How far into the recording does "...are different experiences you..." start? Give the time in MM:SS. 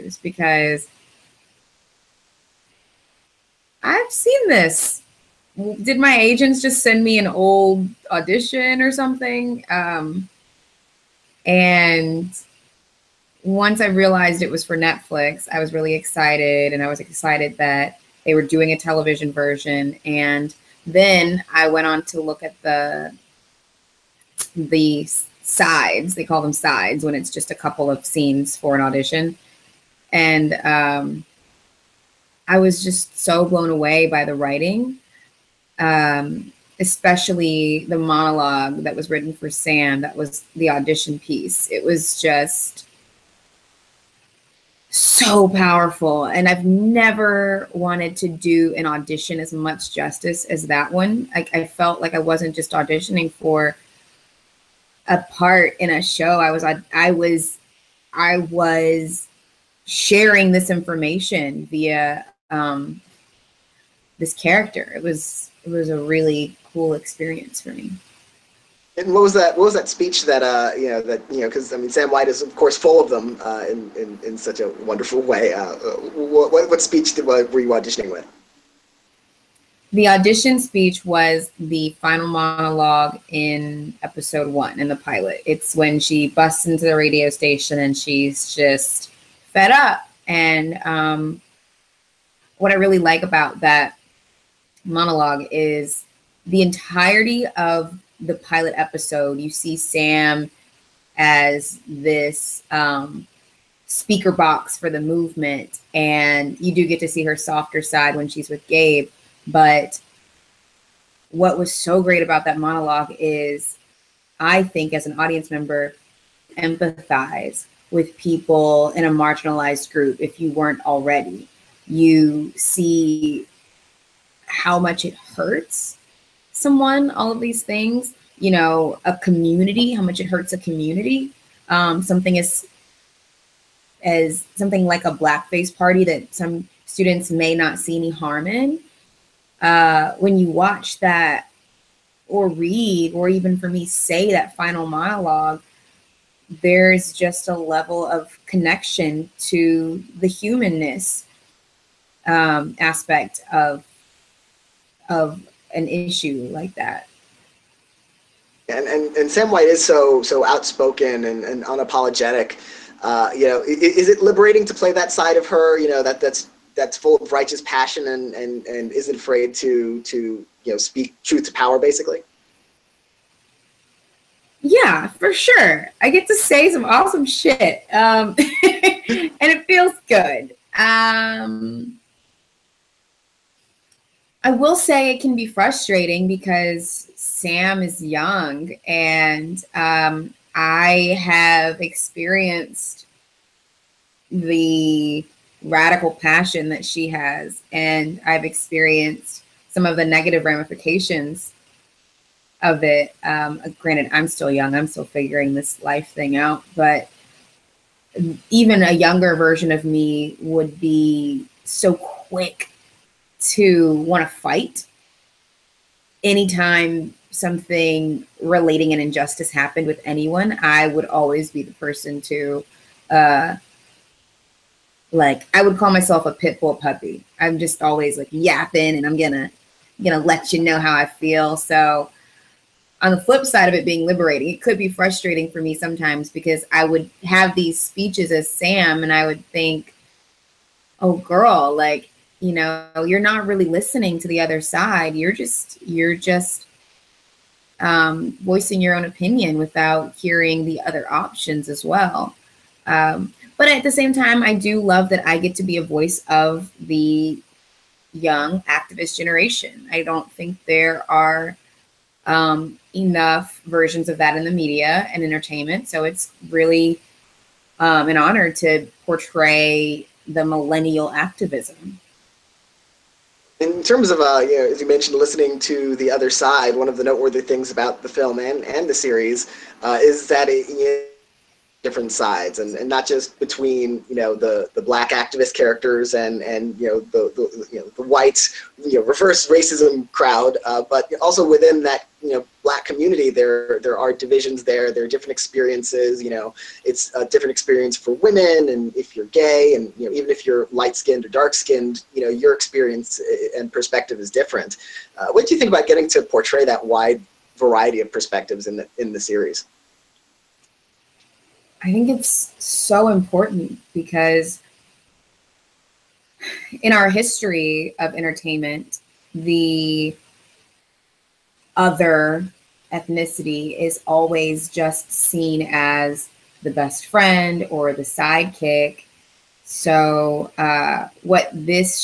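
04:55.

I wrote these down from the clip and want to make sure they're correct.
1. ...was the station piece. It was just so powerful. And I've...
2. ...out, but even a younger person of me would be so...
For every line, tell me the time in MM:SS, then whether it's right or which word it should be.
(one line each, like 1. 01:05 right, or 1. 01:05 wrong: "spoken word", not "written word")
1. 00:40 wrong: "audition", not "station"
2. 03:26 wrong: "version", not "person".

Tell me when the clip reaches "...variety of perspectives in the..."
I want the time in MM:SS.
05:07.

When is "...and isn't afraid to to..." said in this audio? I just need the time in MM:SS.
02:48.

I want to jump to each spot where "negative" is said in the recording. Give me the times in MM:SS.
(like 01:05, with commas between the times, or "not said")
03:20.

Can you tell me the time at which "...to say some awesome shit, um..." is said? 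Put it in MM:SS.
02:56.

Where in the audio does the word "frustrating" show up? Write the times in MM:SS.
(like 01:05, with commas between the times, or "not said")
03:05, 03:54.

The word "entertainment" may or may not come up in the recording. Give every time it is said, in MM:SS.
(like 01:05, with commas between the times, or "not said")
04:25, 05:18.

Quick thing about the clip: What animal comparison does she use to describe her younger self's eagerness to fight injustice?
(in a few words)
pit bull puppy.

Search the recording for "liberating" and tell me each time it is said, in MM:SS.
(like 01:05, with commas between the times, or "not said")
02:44, 03:54.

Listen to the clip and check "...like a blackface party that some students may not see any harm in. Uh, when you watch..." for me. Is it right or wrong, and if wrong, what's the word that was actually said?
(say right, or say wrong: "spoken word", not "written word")
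right.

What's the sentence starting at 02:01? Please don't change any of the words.
You see how much it hurts someone, all of these things, you know, a community, how much it hurts a community.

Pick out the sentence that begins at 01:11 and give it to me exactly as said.
Because I mean, Sam White is of course full of them uh, in, in in such a wonderful way.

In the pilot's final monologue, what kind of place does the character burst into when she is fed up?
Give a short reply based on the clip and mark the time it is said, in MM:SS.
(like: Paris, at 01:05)
radio station, at 01:26.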